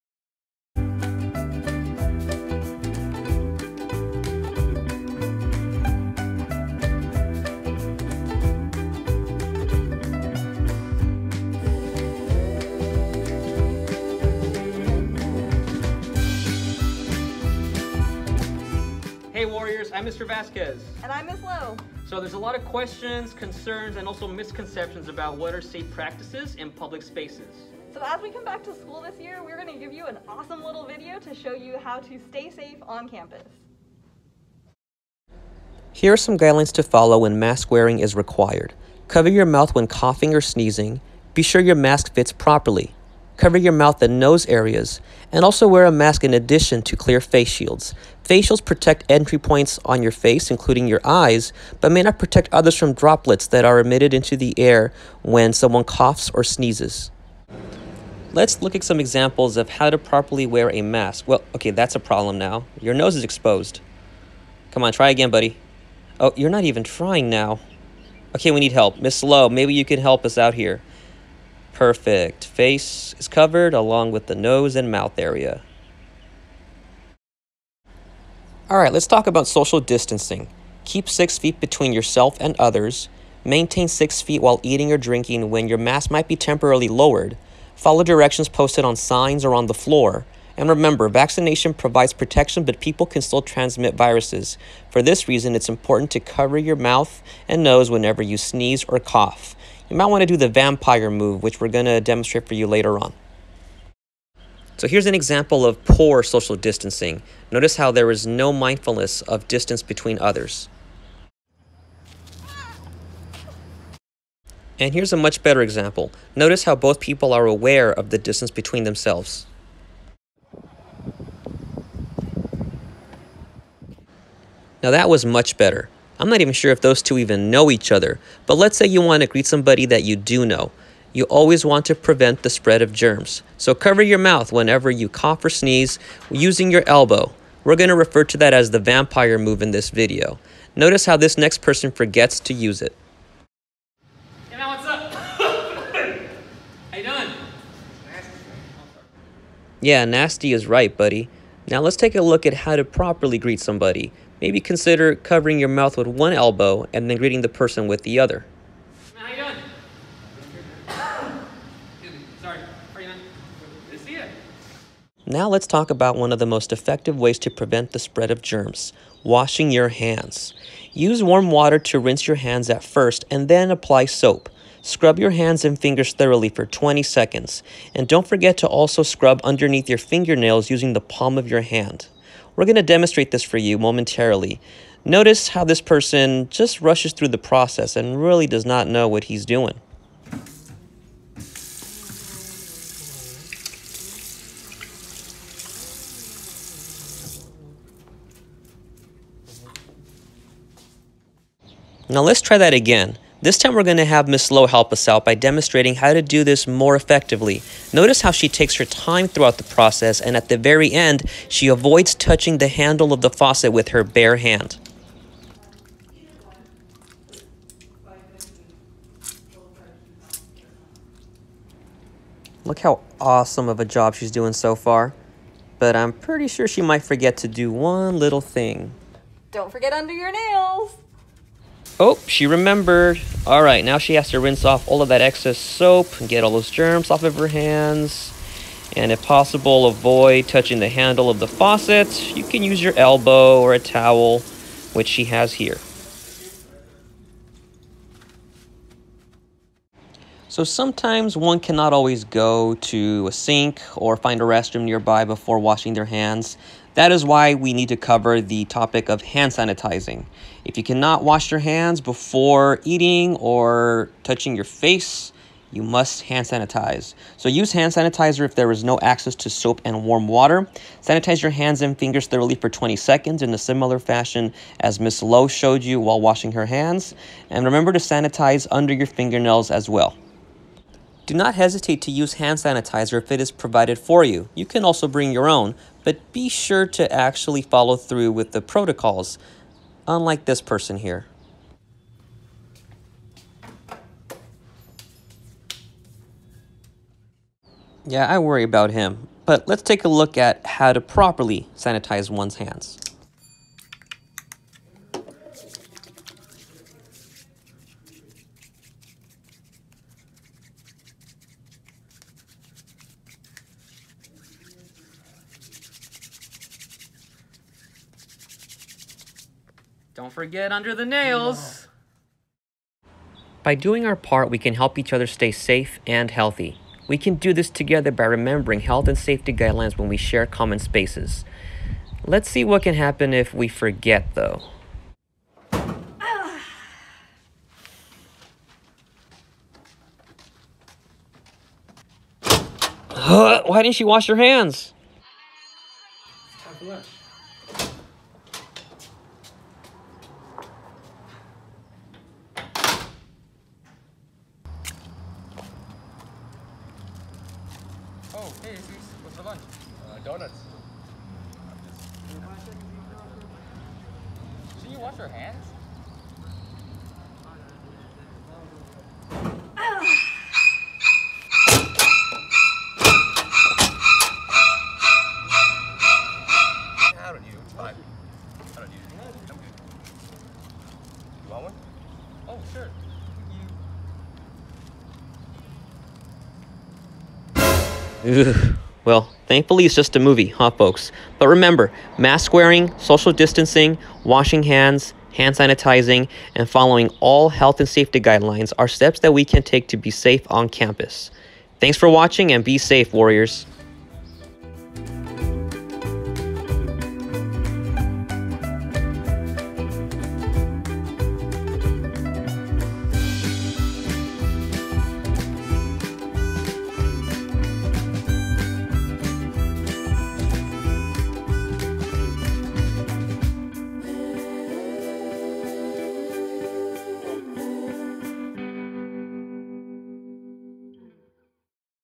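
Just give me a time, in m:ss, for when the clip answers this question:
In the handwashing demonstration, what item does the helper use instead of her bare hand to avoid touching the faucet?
4:03.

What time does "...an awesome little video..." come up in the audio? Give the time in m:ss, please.
0:30.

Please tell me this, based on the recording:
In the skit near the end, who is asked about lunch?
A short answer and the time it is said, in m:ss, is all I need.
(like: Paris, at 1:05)
Aziz, at 5:58.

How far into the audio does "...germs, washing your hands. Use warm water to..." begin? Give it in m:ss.
2:48.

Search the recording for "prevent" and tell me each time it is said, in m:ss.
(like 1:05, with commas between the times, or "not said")
2:11, 2:47.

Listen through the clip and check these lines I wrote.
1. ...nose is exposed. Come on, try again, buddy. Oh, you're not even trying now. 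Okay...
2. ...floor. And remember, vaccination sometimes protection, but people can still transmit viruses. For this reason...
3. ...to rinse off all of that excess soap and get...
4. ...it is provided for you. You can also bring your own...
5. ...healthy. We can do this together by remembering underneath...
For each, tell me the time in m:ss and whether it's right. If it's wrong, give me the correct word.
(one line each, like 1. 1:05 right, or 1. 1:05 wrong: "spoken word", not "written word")
1. 1:02 right
2. 1:29 wrong: "provides", not "sometimes"
3. 3:54 right
4. 4:43 right
5. 5:26 wrong: "health", not "underneath".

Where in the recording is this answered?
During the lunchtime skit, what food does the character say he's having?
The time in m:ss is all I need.
6:00.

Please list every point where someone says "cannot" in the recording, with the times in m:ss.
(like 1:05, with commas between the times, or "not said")
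4:11, 4:20.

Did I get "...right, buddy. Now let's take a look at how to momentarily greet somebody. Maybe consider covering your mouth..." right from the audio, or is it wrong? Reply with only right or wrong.
wrong.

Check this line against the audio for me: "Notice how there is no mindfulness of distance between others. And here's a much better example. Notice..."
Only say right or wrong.
right.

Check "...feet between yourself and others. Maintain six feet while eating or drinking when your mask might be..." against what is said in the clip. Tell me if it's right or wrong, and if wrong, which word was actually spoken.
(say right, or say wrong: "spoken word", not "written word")
right.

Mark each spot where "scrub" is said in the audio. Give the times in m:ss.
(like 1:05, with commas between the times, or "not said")
2:54, 2:59.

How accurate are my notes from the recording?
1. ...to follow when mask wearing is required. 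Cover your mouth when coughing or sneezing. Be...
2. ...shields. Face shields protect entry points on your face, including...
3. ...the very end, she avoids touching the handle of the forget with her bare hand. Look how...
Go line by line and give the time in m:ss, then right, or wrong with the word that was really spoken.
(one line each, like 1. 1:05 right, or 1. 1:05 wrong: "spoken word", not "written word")
1. 0:36 right
2. 0:47 right
3. 3:30 wrong: "faucet", not "forget".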